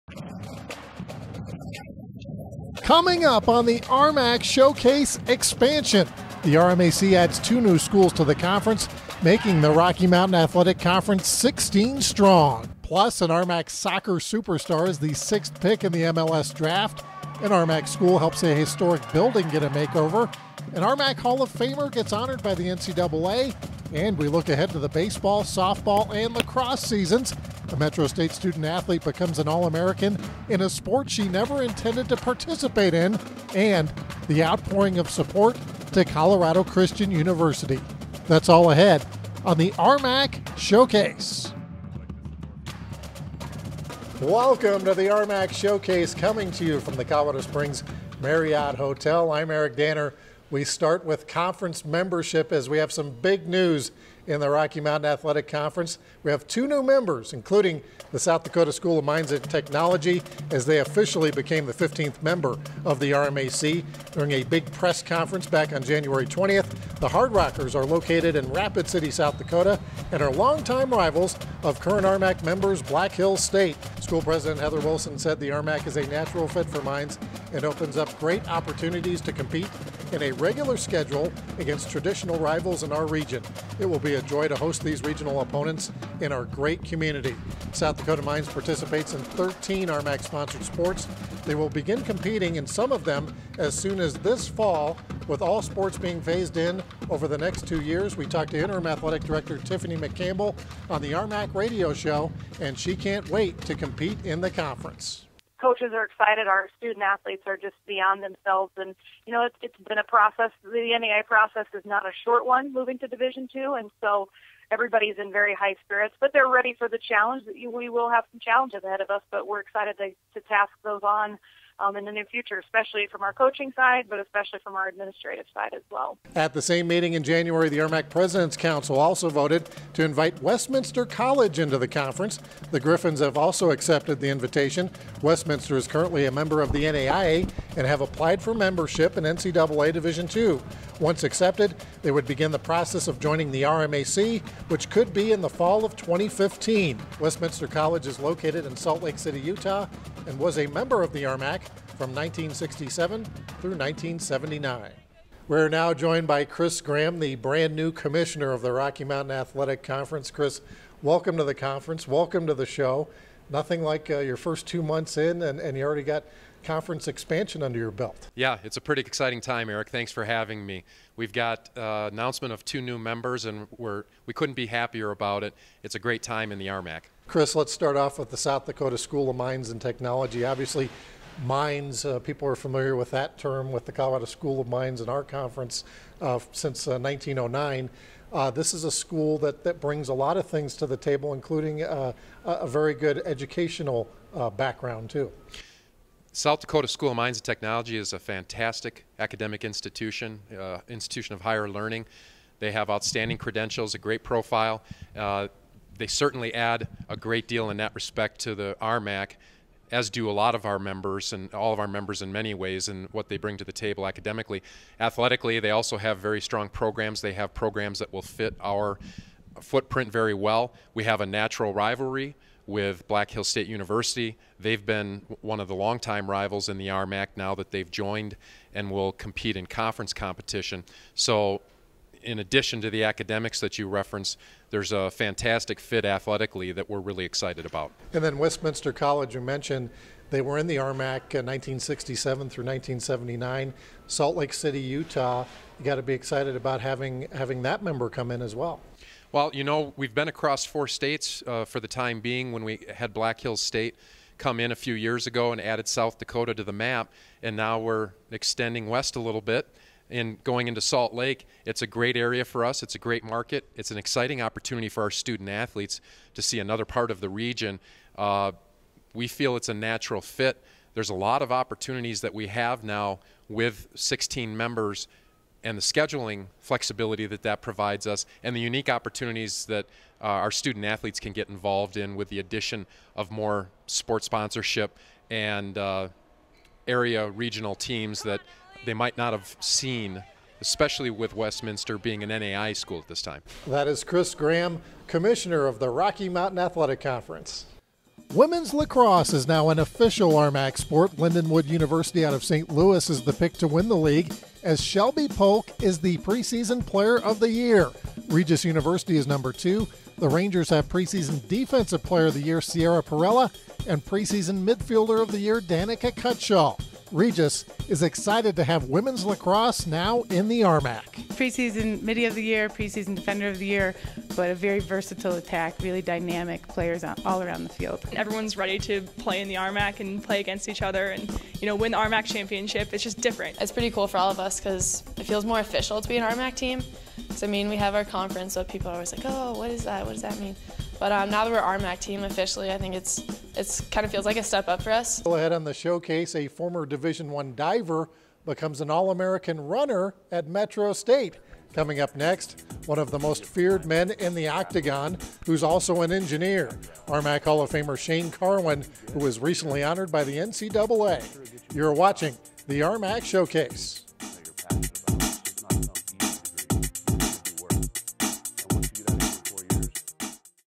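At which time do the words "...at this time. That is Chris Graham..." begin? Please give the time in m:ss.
4:52.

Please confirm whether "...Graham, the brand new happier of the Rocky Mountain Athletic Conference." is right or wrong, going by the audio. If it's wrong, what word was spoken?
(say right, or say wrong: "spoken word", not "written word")
wrong: "commissioner", not "happier".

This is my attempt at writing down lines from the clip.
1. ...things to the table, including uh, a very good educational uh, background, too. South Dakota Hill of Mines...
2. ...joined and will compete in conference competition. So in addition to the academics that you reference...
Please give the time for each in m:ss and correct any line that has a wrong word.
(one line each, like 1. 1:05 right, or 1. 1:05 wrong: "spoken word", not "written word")
1. 3:10 wrong: "School", not "Hill"
2. 3:47 right.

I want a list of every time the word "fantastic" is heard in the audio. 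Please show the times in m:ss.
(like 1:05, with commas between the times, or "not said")
3:18, 3:55.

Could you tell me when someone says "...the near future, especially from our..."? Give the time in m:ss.
2:02.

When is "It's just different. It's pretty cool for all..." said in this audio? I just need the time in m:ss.
5:32.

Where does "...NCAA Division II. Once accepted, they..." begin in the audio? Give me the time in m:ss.
2:19.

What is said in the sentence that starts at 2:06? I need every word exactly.
At the same meeting in January, the RMAC President's Council also voted to invite Westminster College into the conference.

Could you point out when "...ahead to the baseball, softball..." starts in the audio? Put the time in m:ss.
0:24.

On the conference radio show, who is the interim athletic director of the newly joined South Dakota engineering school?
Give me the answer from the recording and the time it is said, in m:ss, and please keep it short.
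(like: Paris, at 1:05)
Tiffany McCampbell, at 1:39.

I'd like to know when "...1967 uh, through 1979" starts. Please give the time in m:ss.
4:01.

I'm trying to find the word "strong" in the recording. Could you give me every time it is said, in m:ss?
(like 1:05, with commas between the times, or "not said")
0:12, 3:36.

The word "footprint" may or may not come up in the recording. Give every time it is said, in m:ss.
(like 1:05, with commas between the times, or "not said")
3:39.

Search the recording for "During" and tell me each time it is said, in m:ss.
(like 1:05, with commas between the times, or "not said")
1:04.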